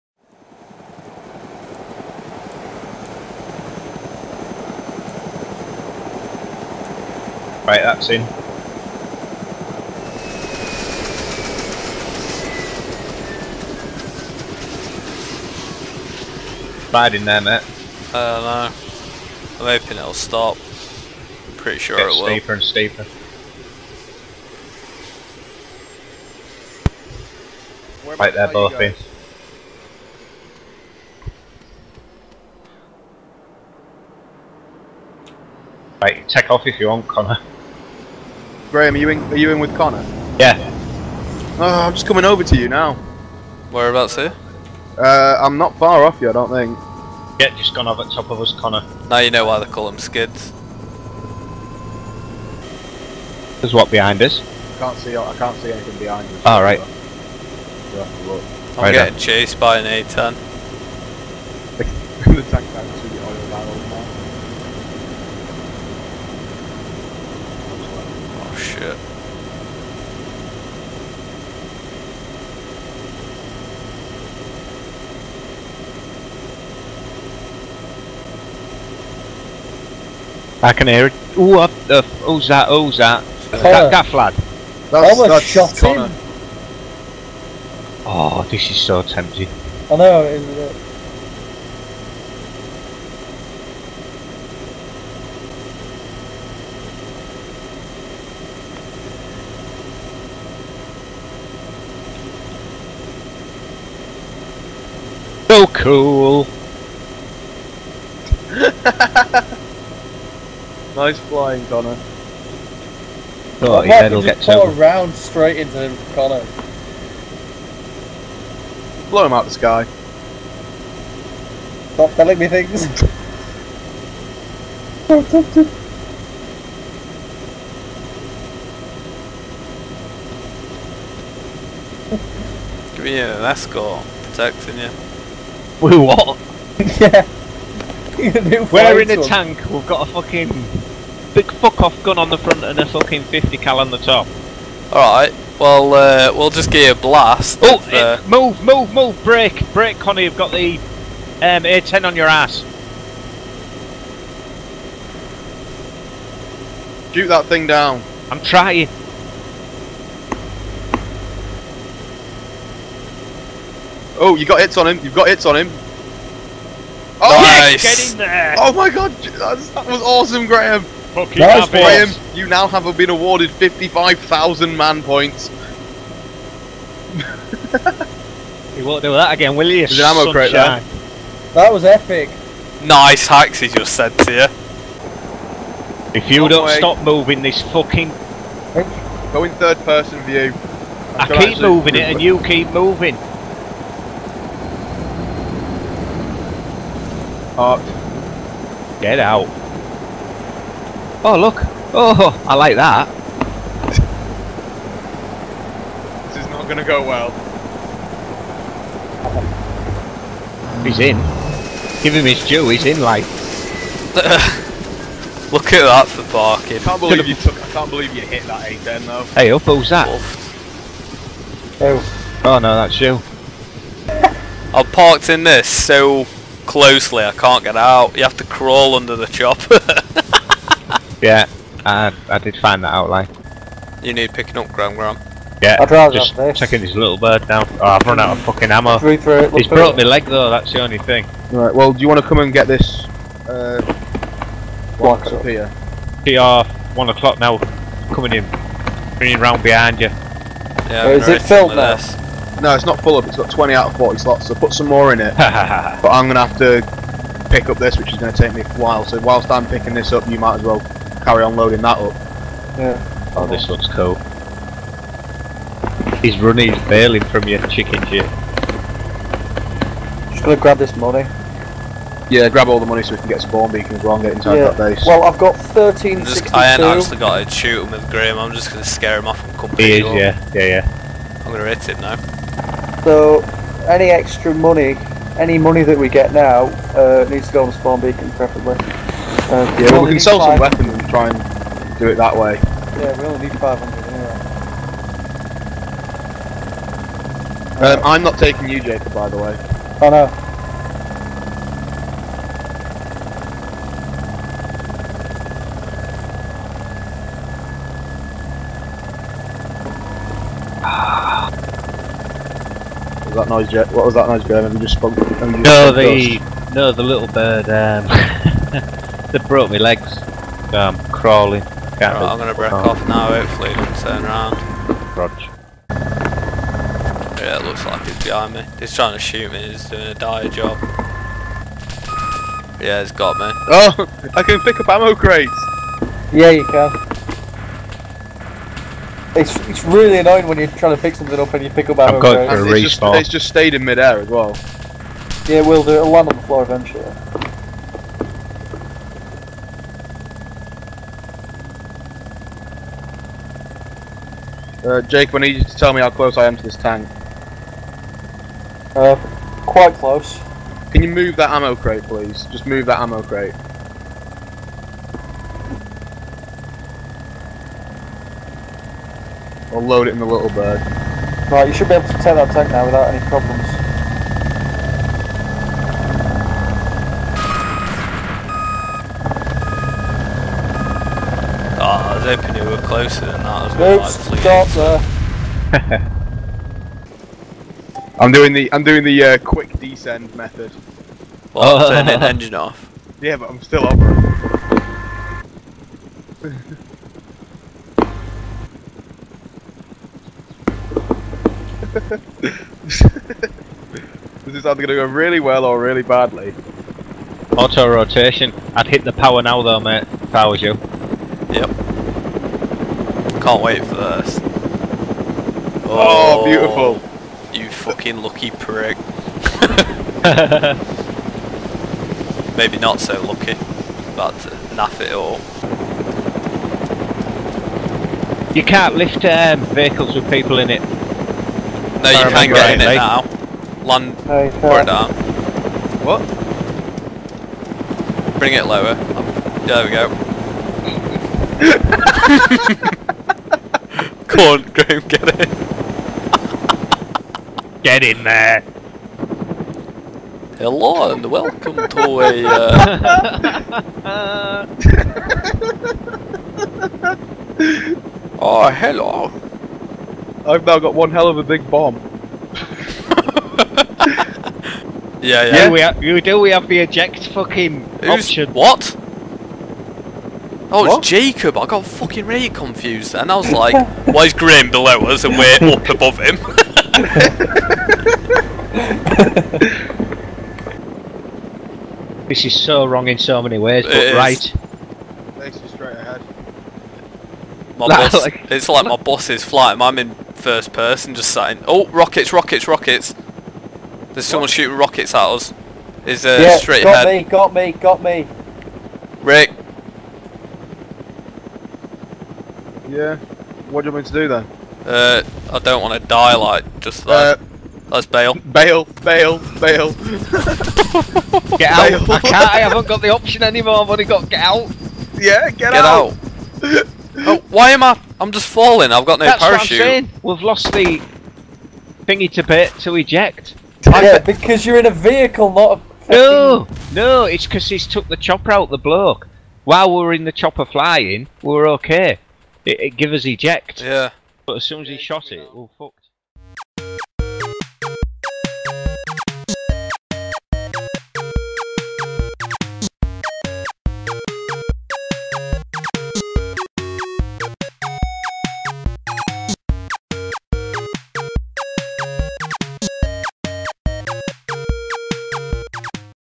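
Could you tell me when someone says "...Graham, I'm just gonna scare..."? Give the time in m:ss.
4:38.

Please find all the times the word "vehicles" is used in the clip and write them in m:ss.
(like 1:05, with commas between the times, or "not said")
7:09, 8:44.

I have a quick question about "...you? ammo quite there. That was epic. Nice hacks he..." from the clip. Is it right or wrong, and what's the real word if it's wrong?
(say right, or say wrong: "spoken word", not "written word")
wrong: "crate", not "quite".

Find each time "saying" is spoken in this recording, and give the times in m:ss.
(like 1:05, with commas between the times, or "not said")
8:11, 8:39.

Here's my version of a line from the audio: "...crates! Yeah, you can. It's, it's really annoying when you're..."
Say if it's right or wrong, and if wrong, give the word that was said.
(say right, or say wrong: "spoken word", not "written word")
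right.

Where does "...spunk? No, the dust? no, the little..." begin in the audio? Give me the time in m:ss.
5:14.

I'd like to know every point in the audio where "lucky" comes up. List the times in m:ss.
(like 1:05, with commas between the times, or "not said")
6:58, 7:03.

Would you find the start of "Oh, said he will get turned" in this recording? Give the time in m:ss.
1:53.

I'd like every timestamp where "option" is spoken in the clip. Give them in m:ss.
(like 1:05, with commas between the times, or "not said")
7:48, 8:33.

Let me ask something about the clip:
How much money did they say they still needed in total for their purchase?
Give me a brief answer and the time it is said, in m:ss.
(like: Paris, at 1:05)
500, at 4:53.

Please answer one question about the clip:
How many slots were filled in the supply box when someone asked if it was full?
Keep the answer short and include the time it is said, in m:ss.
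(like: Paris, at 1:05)
20, at 4:13.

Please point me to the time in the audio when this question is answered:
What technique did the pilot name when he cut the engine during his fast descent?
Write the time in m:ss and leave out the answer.
6:47.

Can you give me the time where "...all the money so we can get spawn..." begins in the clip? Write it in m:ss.
4:32.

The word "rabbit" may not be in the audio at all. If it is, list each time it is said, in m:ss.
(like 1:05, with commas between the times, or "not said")
not said.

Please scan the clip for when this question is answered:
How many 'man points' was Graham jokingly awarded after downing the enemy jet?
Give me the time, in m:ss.
2:53.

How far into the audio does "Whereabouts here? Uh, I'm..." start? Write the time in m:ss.
0:43.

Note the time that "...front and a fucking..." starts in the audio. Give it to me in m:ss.
2:22.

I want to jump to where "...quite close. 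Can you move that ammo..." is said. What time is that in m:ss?
5:59.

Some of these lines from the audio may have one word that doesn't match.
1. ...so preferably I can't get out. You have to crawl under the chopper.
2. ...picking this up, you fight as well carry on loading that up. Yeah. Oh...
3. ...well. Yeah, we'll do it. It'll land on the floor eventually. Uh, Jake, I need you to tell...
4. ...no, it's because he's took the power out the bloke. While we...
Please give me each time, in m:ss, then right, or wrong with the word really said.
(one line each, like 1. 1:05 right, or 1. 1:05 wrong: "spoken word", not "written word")
1. 3:45 wrong: "closely", not "preferably"
2. 4:19 wrong: "might", not "fight"
3. 5:44 right
4. 8:46 wrong: "chopper", not "power".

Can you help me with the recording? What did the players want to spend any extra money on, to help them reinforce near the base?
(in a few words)
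spawn beacons.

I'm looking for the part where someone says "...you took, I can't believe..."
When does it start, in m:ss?
3:37.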